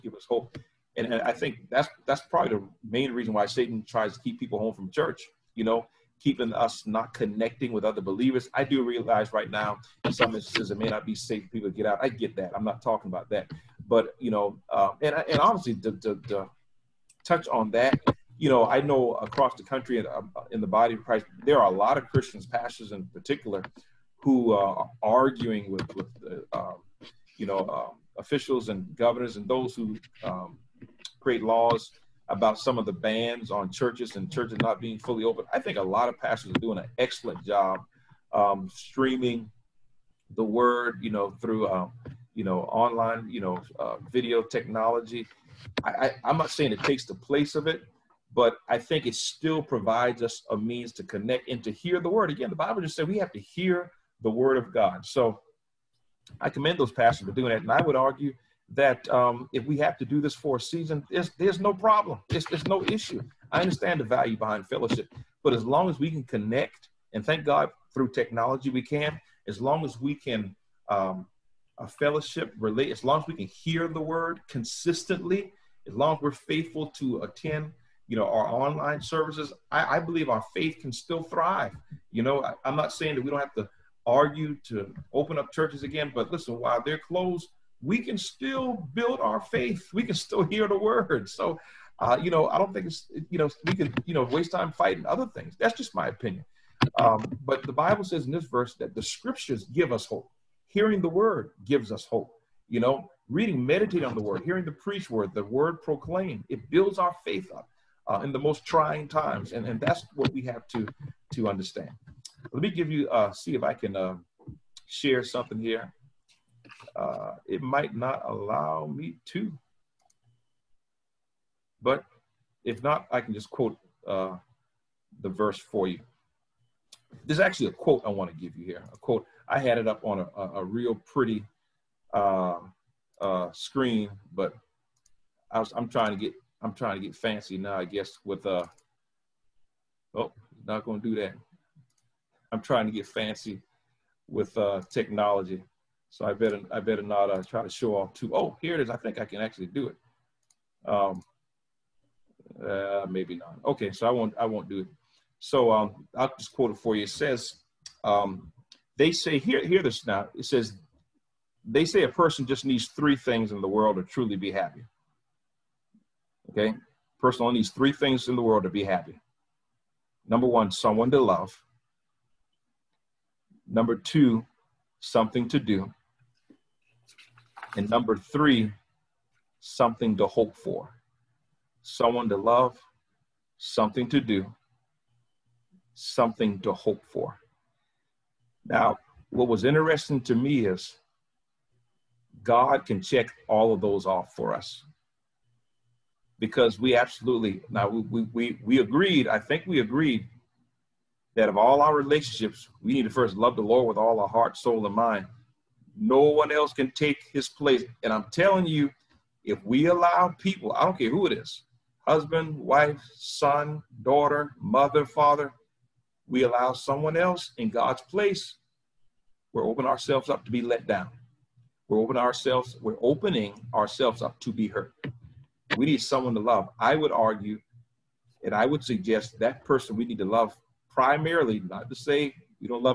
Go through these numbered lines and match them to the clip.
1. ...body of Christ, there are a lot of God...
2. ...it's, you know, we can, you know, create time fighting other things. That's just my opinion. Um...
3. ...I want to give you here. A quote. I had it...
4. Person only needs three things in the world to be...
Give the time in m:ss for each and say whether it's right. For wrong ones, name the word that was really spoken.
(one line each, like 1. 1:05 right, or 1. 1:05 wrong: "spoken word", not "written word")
1. 0:20 wrong: "Christians", not "God"
2. 1:32 wrong: "waste", not "create"
3. 2:08 right
4. 2:47 right.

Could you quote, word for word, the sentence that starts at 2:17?
I guess with uh oh, not gonna do that.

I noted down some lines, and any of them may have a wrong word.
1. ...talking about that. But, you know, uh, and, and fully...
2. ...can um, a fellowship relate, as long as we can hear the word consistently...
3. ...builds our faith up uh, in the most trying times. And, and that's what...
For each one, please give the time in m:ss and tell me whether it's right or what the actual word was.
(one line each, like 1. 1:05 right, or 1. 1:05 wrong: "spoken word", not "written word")
1. 0:12 wrong: "obviously", not "fully"
2. 1:10 right
3. 1:46 right.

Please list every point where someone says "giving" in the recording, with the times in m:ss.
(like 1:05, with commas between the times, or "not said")
not said.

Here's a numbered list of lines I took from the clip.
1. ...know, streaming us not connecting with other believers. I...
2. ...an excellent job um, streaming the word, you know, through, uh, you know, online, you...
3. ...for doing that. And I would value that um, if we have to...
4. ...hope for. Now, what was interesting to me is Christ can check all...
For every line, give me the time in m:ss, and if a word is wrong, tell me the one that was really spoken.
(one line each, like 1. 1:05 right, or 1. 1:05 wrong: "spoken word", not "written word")
1. 0:05 wrong: "keeping", not "streaming"
2. 0:36 right
3. 0:57 wrong: "argue", not "value"
4. 3:06 wrong: "God", not "Christ".